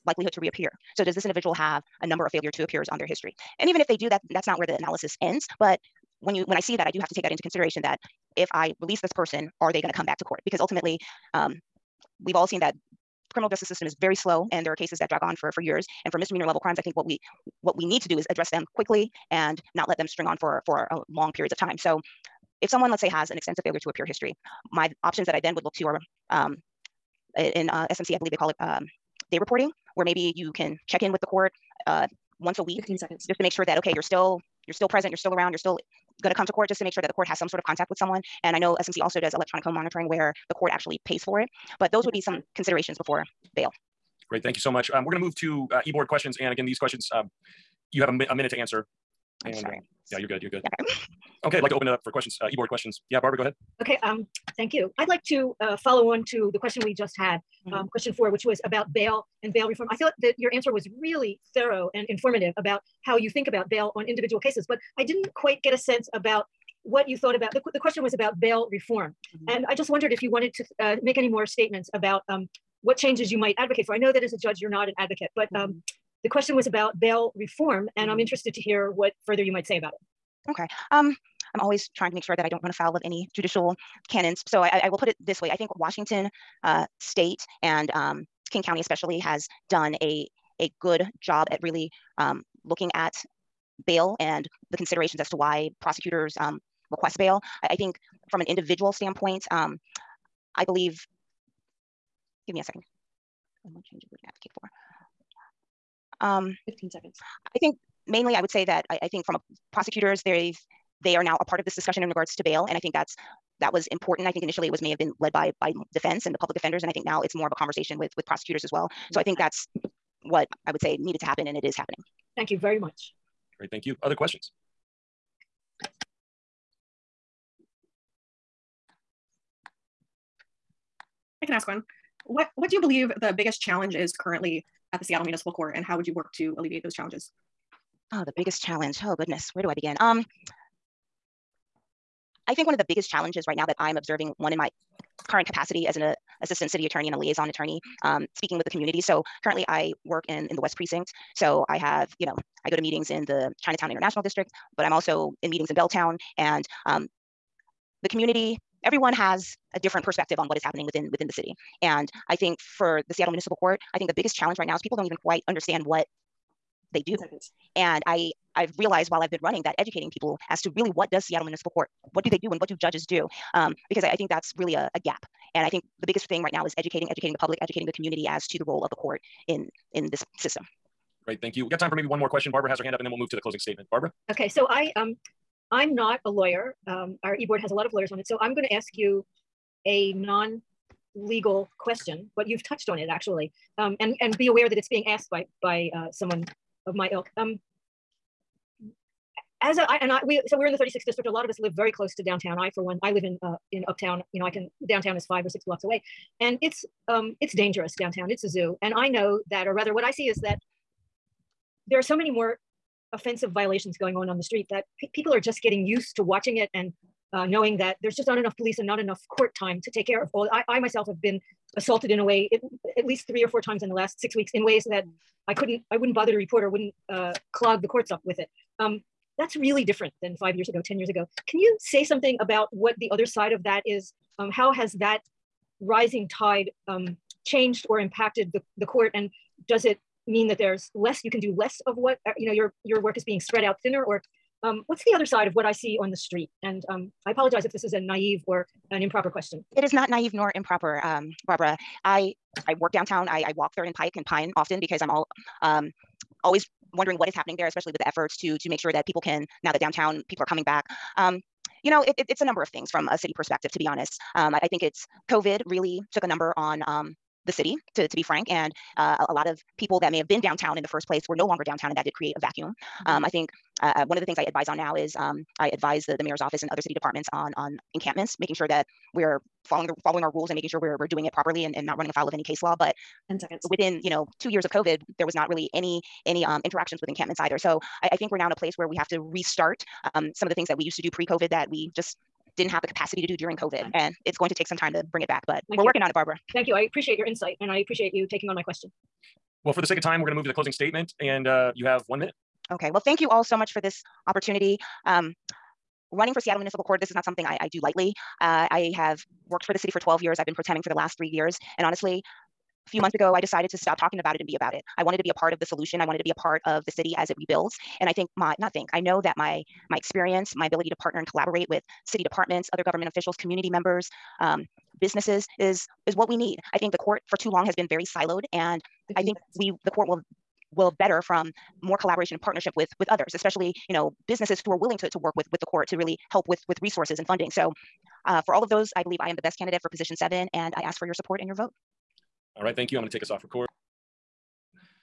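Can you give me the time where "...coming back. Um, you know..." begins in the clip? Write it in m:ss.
4:20.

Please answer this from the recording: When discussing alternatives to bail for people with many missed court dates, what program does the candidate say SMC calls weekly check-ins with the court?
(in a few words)
day reporting.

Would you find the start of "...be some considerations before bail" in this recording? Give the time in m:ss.
0:42.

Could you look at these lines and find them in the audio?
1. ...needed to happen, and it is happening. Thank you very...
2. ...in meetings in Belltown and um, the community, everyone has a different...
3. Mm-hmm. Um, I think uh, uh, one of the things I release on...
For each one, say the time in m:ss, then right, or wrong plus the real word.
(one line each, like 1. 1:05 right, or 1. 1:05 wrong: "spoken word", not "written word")
1. 2:00 right
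2. 2:35 right
3. 4:33 wrong: "advise", not "release".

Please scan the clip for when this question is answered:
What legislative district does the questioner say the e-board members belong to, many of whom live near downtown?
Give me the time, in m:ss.
3:20.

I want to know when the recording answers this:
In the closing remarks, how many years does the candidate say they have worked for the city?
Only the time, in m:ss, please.
5:09.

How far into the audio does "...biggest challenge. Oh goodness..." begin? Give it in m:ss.
2:18.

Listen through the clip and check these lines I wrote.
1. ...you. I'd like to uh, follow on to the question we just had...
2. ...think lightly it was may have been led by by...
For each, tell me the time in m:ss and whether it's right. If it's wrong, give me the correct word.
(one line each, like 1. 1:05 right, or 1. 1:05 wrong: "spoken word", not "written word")
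1. 0:54 right
2. 1:54 wrong: "initially", not "lightly".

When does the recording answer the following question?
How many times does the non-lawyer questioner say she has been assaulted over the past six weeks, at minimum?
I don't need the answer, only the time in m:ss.
3:43.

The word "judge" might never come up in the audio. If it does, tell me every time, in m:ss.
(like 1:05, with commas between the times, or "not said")
1:14, 2:52.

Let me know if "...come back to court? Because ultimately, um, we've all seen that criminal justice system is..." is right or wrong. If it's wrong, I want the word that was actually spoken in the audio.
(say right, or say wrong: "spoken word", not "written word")
right.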